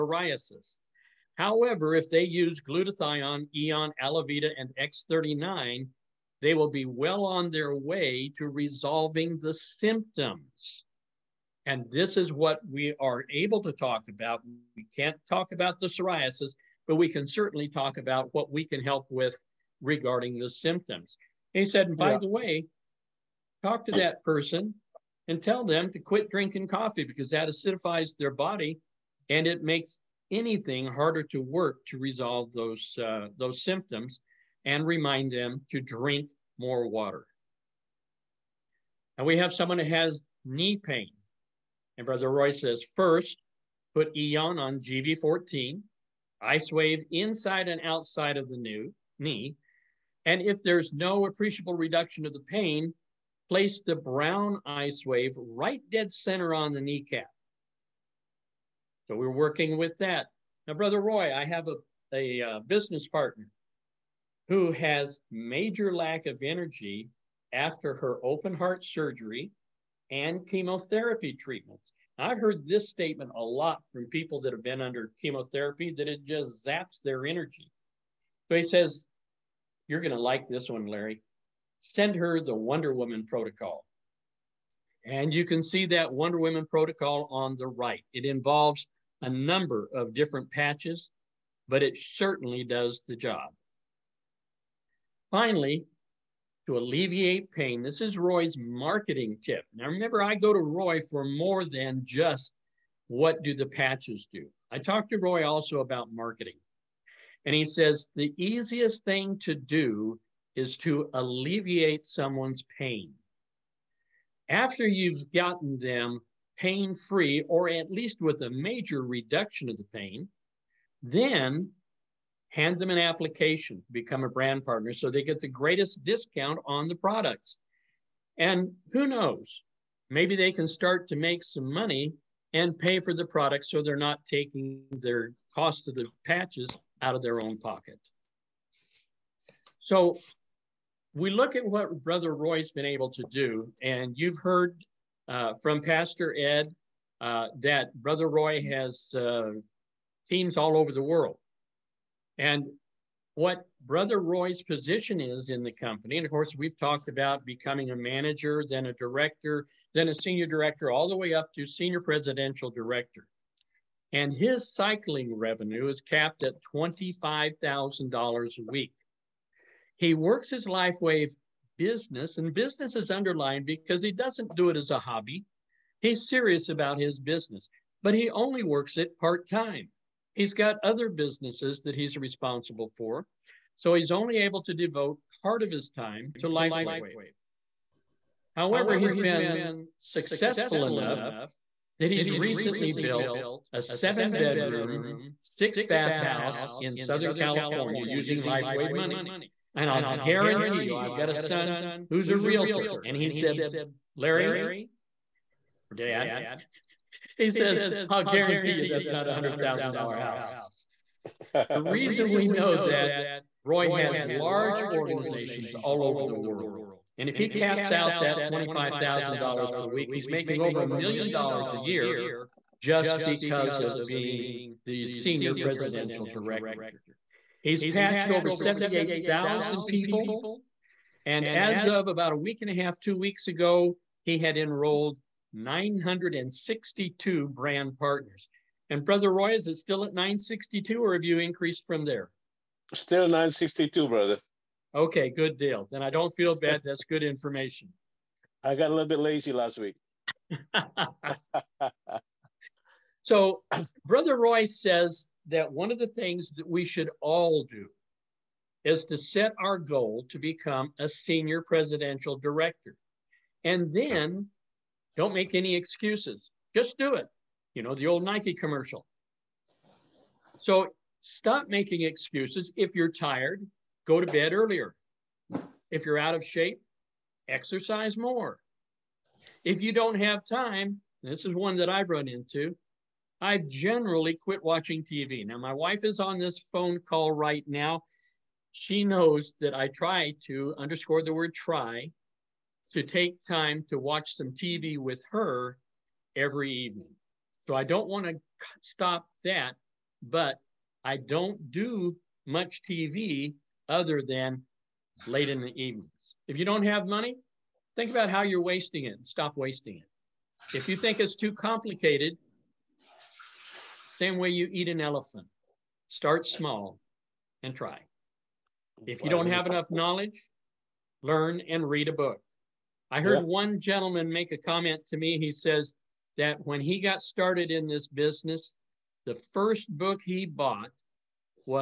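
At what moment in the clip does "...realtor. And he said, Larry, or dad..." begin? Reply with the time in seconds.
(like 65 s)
202 s.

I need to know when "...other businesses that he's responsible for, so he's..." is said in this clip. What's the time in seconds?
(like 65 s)
180 s.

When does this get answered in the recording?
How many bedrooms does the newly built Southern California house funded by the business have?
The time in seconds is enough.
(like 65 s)
193 s.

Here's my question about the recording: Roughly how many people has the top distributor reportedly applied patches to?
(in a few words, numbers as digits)
78,000.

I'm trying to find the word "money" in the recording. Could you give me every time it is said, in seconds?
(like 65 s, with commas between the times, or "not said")
131 s, 198 s, 307 s.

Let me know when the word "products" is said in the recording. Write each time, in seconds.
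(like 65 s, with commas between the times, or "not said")
126 s, 133 s.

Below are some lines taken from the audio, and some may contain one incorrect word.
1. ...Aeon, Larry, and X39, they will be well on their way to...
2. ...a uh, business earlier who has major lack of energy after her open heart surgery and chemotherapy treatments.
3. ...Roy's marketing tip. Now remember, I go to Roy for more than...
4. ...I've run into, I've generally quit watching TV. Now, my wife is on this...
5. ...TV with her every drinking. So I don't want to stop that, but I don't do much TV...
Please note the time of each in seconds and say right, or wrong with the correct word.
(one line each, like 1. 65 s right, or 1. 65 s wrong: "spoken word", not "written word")
1. 3 s wrong: "Alavida", not "Larry"
2. 62 s wrong: "partner", not "earlier"
3. 98 s right
4. 281 s right
5. 294 s wrong: "evening", not "drinking".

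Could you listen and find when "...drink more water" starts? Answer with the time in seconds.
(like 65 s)
35 s.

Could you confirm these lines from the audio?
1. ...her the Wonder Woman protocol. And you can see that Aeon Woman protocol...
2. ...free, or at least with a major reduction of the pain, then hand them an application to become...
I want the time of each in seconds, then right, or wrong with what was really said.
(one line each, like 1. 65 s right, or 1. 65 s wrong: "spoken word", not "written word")
1. 82 s wrong: "Wonder", not "Aeon"
2. 116 s right.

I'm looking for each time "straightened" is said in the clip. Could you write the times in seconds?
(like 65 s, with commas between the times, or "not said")
not said.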